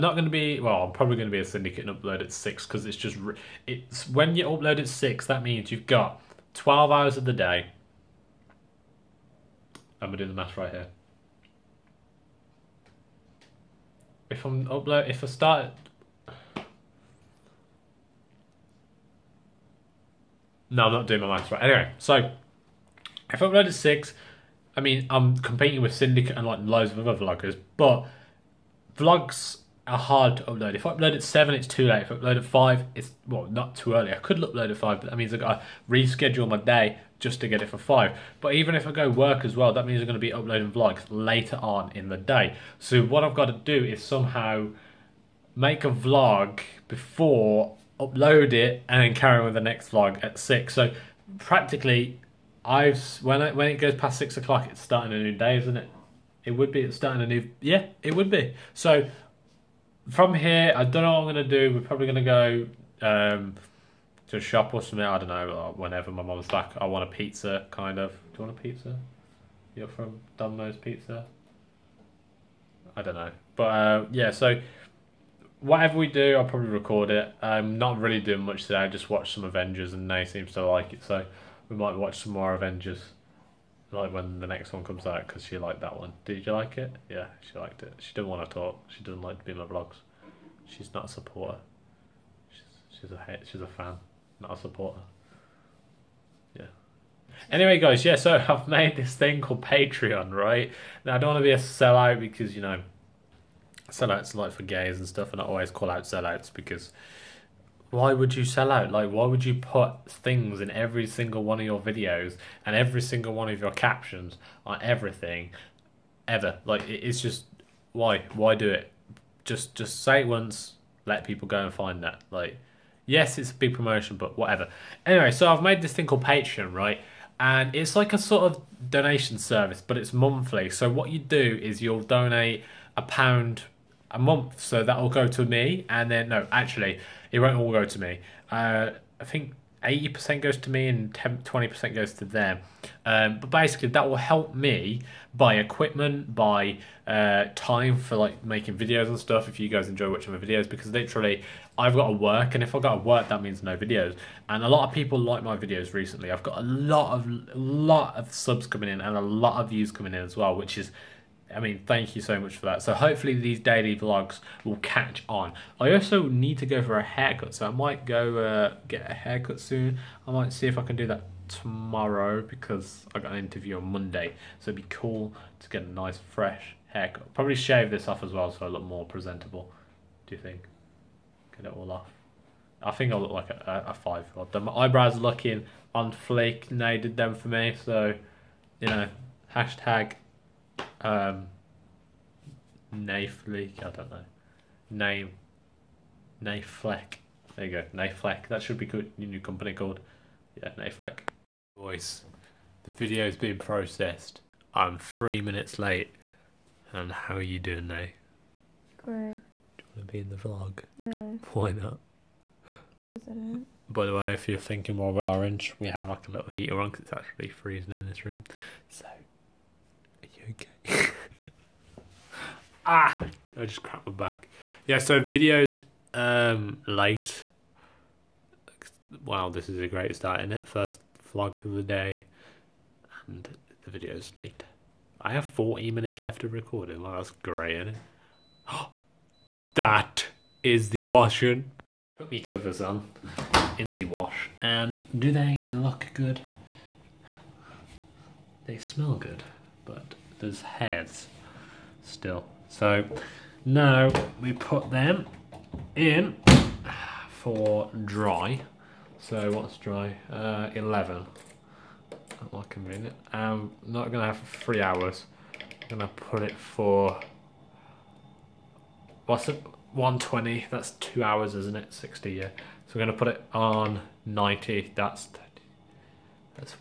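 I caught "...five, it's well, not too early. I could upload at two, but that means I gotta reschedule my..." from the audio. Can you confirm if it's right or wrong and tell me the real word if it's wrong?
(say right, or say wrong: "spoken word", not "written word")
wrong: "five", not "two".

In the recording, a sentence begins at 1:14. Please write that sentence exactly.
So whatever we do, I'll probably record it.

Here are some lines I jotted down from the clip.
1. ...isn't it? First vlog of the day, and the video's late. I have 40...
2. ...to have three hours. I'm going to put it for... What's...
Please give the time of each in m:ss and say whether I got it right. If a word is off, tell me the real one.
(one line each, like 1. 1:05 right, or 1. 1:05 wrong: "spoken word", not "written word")
1. 3:50 right
2. 4:24 right.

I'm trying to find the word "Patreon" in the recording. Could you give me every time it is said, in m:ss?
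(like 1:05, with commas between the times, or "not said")
1:39, 2:06.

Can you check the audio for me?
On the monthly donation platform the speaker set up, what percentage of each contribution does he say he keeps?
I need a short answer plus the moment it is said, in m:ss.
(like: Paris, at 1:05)
80 percent, at 2:19.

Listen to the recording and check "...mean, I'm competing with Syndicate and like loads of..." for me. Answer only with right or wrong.
right.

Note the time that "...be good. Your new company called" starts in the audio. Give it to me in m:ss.
3:18.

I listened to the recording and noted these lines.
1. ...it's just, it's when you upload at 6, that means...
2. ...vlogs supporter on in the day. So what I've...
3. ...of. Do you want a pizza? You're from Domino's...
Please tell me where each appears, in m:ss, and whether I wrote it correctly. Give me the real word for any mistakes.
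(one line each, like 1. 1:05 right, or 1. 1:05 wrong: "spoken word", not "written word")
1. 0:02 right
2. 0:40 wrong: "later", not "supporter"
3. 1:07 right.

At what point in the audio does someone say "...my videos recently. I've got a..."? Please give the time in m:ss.
2:35.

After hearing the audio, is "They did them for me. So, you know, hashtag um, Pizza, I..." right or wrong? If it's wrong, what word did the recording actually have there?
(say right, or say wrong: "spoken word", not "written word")
wrong: "Nayfleek", not "Pizza".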